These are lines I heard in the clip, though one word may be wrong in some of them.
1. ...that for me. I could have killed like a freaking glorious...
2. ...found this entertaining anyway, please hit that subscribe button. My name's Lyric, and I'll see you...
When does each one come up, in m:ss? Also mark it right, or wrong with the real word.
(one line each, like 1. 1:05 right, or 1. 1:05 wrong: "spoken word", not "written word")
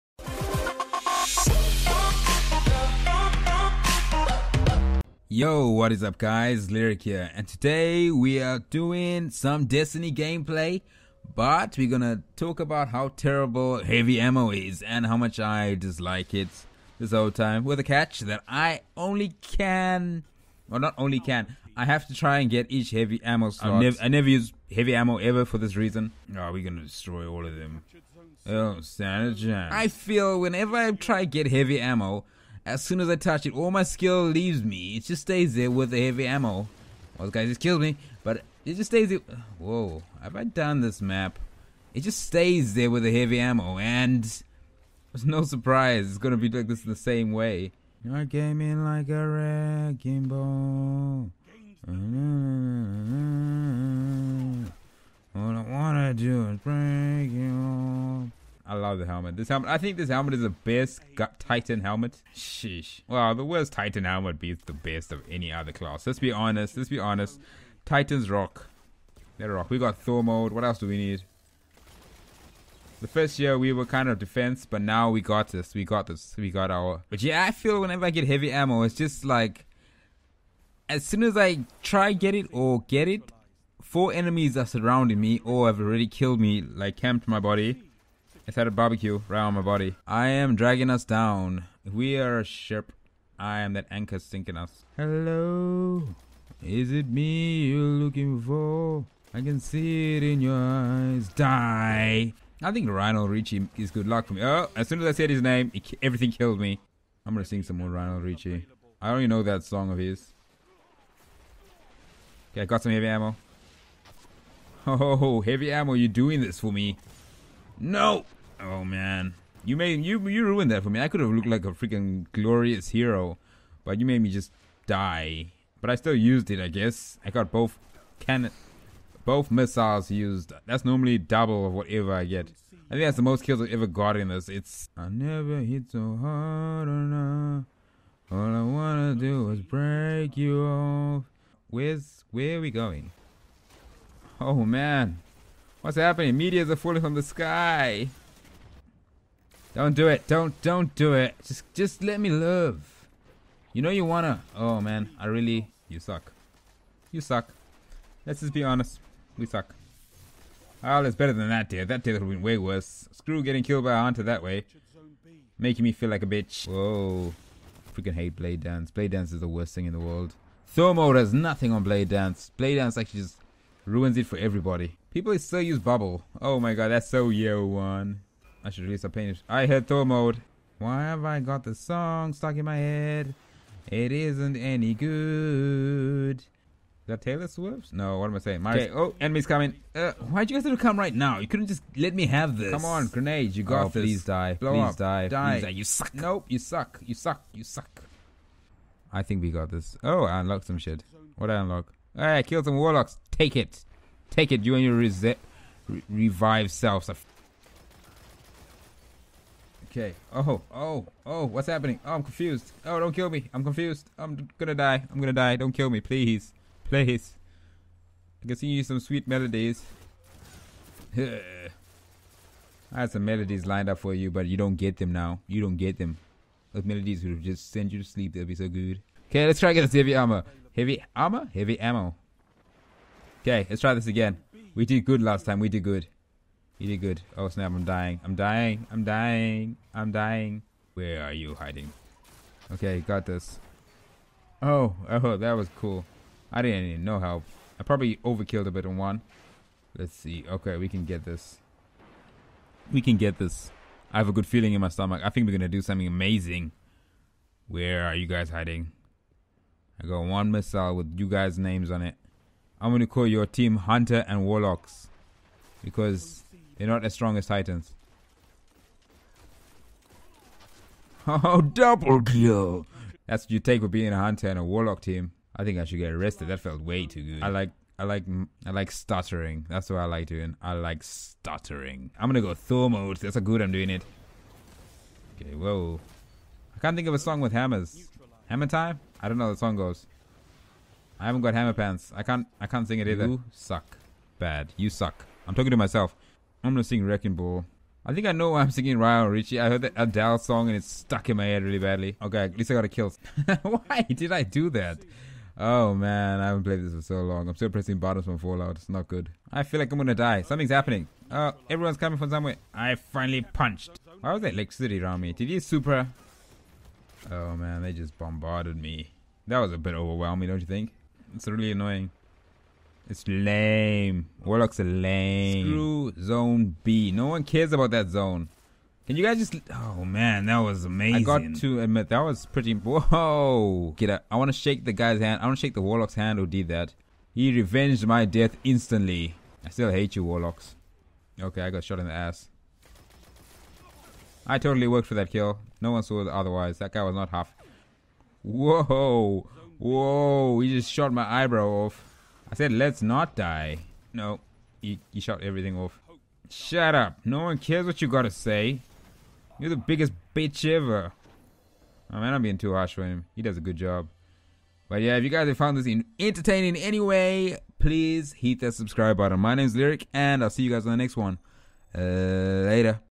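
1. 2:00 wrong: "looked", not "killed"
2. 6:05 right.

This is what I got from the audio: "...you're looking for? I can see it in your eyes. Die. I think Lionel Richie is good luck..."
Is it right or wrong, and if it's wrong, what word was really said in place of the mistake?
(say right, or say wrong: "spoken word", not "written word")
right.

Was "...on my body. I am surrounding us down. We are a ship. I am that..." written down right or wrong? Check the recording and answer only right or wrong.
wrong.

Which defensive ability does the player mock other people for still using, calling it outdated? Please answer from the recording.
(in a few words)
Bubble.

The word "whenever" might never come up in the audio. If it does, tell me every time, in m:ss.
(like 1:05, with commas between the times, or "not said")
0:30, 1:17.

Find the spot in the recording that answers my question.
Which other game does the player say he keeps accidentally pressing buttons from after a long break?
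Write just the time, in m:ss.
5:08.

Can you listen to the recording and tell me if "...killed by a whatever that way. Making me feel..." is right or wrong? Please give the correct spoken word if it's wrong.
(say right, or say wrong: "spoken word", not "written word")
wrong: "hunter", not "whatever".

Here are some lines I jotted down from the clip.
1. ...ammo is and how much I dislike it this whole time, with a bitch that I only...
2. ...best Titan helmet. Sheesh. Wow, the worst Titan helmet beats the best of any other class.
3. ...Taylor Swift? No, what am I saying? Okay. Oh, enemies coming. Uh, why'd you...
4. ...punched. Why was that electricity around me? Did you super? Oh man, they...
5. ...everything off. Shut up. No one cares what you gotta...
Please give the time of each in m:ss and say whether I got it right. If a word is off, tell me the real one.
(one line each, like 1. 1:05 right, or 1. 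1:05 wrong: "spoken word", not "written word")
1. 0:14 wrong: "catch", not "bitch"
2. 1:00 right
3. 3:07 right
4. 5:13 right
5. 5:55 right.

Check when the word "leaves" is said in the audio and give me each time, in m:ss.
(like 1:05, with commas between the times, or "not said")
0:34.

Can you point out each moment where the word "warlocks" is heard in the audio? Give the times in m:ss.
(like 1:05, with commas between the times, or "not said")
3:22, 4:24, 4:34, 5:24, 5:35, 5:40.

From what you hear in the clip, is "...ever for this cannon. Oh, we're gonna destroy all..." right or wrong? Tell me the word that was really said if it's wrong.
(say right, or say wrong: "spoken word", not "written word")
wrong: "reason", not "cannon".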